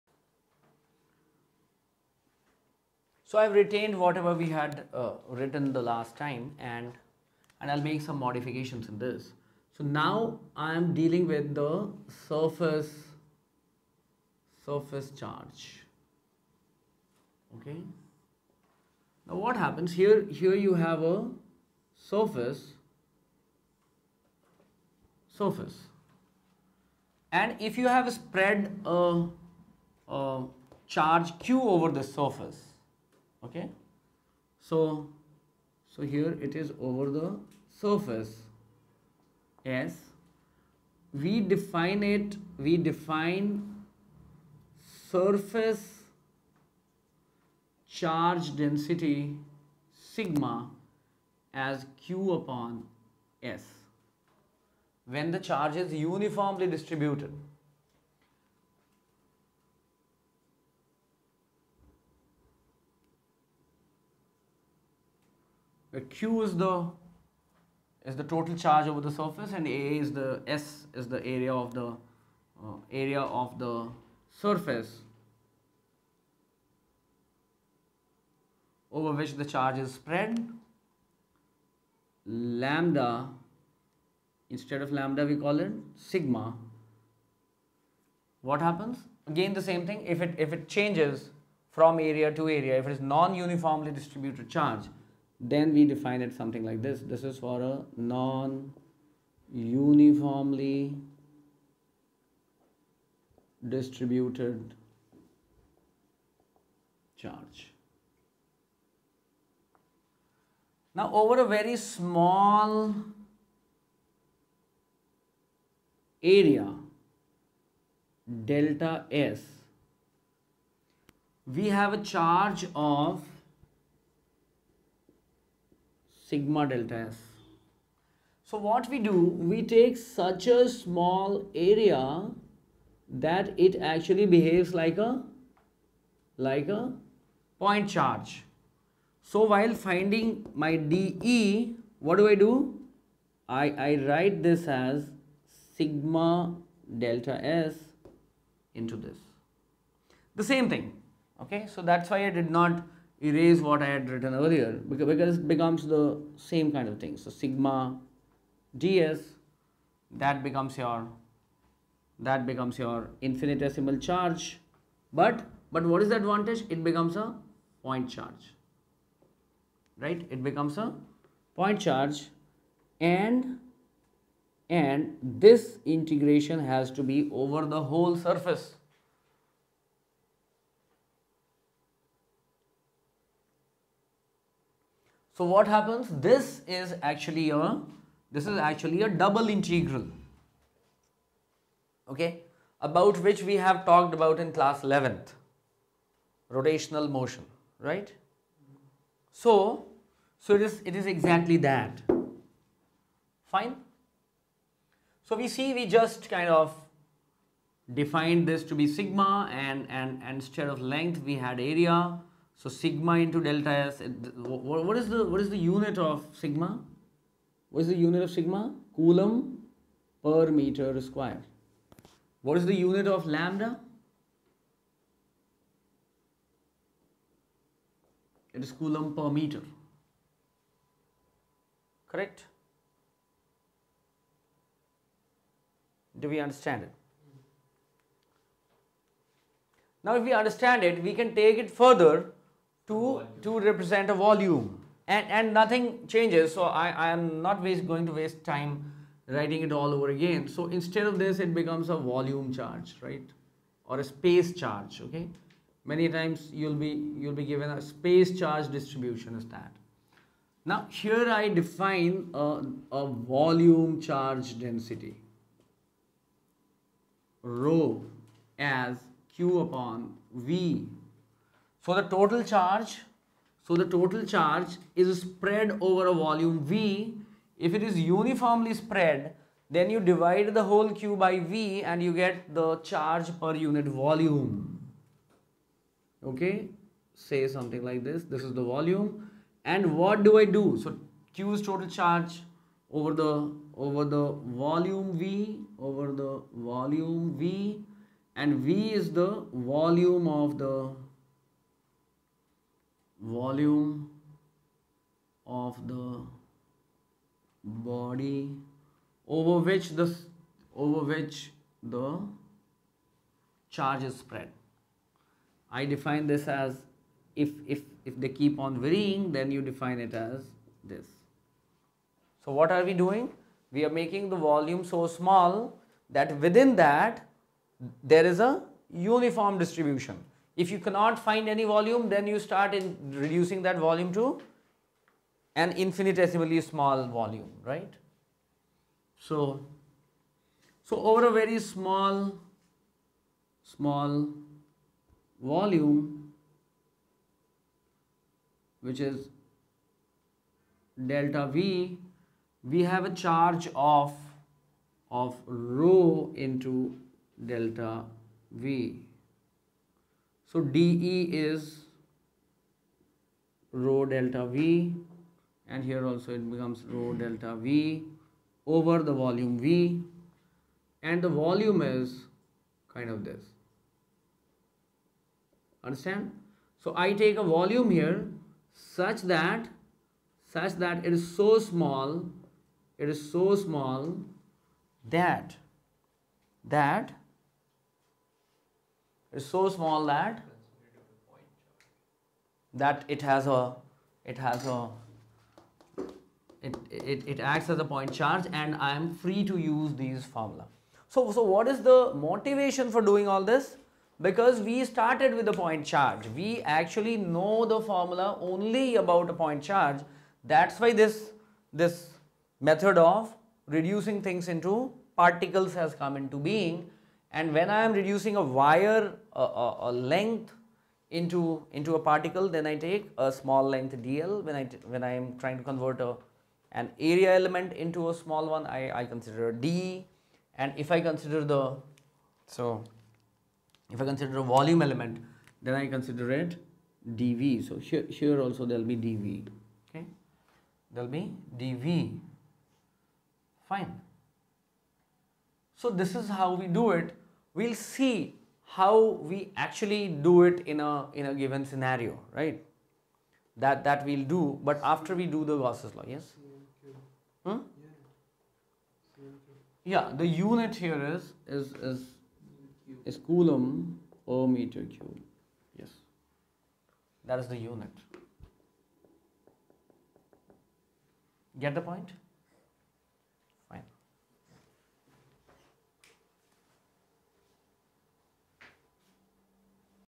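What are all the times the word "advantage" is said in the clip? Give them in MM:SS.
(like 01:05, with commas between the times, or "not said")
02:46.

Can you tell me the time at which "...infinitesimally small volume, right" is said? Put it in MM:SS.
05:35.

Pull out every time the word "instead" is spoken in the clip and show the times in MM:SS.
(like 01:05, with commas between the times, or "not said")
01:24, 03:30, 04:10.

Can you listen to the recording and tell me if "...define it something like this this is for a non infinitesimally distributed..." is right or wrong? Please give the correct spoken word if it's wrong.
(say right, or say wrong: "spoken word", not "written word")
wrong: "uniformly", not "infinitesimally".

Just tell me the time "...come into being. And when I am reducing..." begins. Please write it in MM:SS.
06:55.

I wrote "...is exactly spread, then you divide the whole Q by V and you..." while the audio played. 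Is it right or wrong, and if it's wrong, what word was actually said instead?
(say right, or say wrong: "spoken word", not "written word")
wrong: "uniformly", not "exactly".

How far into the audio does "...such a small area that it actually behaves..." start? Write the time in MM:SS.
02:10.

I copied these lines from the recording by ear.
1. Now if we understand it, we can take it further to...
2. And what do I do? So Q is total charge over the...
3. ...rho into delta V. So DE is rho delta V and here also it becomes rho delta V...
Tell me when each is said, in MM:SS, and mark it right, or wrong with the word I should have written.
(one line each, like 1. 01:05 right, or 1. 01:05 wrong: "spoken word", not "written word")
1. 04:00 right
2. 04:49 right
3. 05:55 right.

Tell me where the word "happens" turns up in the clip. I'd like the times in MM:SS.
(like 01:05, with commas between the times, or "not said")
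00:19, 01:28, 03:05.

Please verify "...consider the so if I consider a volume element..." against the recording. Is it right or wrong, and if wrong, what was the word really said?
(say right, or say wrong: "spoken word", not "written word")
right.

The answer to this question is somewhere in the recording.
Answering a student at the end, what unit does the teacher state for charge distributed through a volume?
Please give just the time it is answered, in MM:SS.
07:43.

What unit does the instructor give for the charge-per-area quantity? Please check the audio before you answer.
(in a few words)
coulomb per meter square.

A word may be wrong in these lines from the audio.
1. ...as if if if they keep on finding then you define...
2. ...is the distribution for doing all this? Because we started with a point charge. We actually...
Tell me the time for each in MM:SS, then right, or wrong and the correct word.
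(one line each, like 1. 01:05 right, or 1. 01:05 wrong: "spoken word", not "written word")
1. 05:16 wrong: "varying", not "finding"
2. 06:41 wrong: "motivation", not "distribution".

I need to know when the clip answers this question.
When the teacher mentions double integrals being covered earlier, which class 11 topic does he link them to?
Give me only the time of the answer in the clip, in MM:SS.
03:16.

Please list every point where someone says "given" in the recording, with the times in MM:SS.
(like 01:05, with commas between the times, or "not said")
04:17, 07:31.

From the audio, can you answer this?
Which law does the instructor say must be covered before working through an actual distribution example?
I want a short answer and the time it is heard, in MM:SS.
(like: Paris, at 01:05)
Gauss's law, at 07:35.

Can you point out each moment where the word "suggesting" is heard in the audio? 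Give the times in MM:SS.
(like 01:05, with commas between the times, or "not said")
not said.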